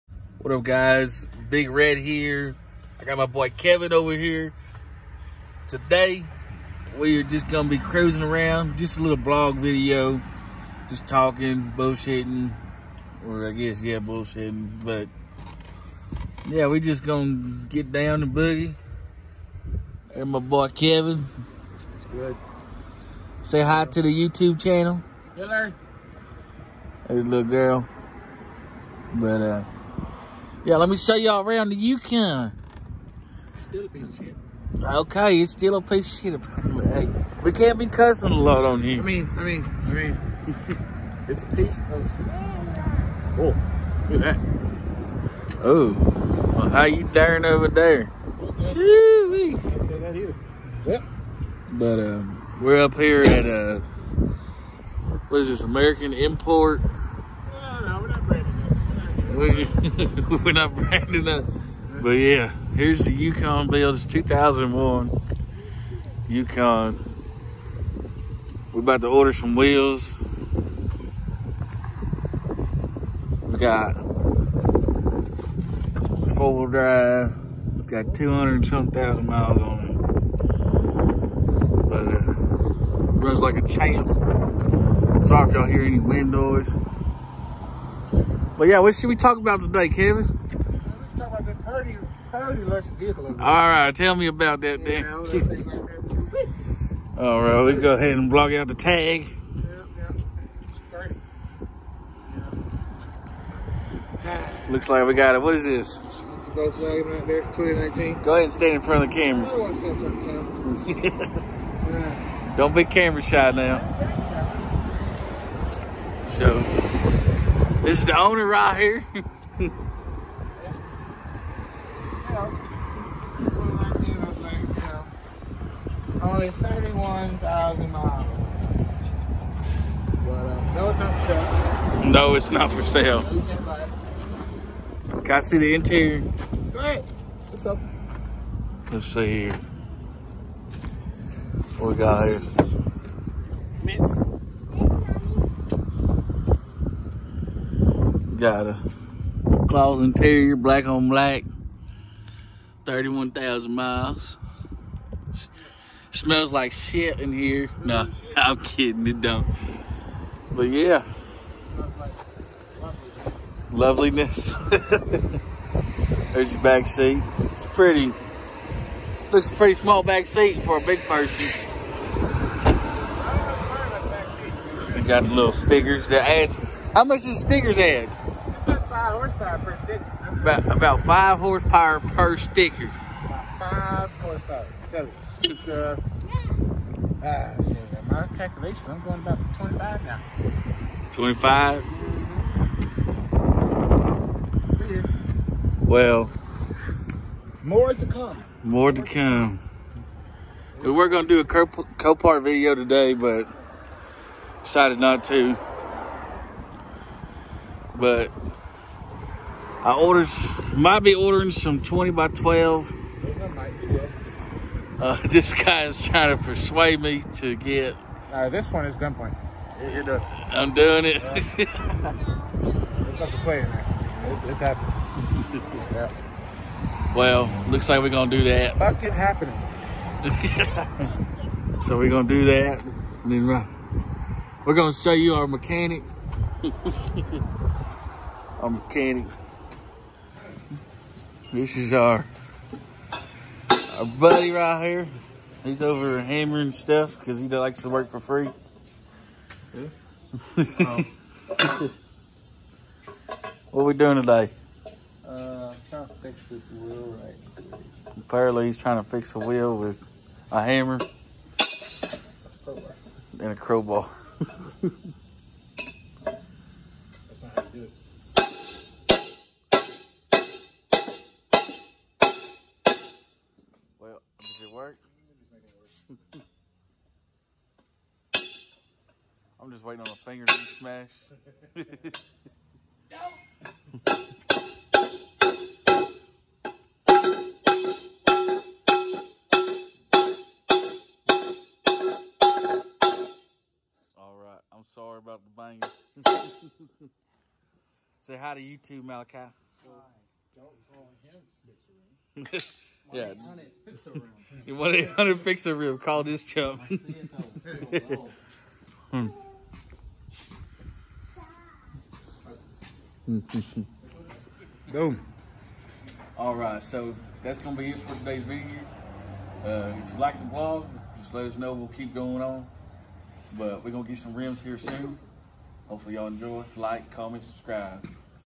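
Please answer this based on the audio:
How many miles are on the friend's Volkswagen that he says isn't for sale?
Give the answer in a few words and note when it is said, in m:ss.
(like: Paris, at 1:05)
31,000, at 2:06.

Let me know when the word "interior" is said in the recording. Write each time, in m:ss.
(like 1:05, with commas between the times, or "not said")
2:15, 2:30.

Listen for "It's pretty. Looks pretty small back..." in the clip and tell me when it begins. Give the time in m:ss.
2:47.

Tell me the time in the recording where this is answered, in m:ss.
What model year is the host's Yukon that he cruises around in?
1:04.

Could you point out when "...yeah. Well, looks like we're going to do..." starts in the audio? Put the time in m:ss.
3:45.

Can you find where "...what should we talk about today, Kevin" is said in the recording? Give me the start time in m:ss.
1:28.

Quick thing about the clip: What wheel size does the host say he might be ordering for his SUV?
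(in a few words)
20 by 12.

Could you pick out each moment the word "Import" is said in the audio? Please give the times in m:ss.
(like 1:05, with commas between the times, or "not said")
0:56.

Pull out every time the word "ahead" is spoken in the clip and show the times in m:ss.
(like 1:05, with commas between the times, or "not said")
1:37, 1:48, 2:16.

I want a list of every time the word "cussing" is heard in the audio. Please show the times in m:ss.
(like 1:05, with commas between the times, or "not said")
0:37.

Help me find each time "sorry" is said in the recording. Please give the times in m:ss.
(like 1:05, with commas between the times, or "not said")
1:25, 4:54.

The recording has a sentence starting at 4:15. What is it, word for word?
Uh, I'm trying to fix this wheel right.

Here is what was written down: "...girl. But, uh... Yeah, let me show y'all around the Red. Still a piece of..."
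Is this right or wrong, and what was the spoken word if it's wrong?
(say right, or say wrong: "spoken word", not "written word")
wrong: "Yukon", not "Red".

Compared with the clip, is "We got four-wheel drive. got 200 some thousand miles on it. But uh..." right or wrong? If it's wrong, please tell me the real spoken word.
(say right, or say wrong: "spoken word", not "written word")
right.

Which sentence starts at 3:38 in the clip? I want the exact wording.
All right, this one is gunpoint.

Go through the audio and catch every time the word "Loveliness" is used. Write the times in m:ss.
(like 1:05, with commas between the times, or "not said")
2:43.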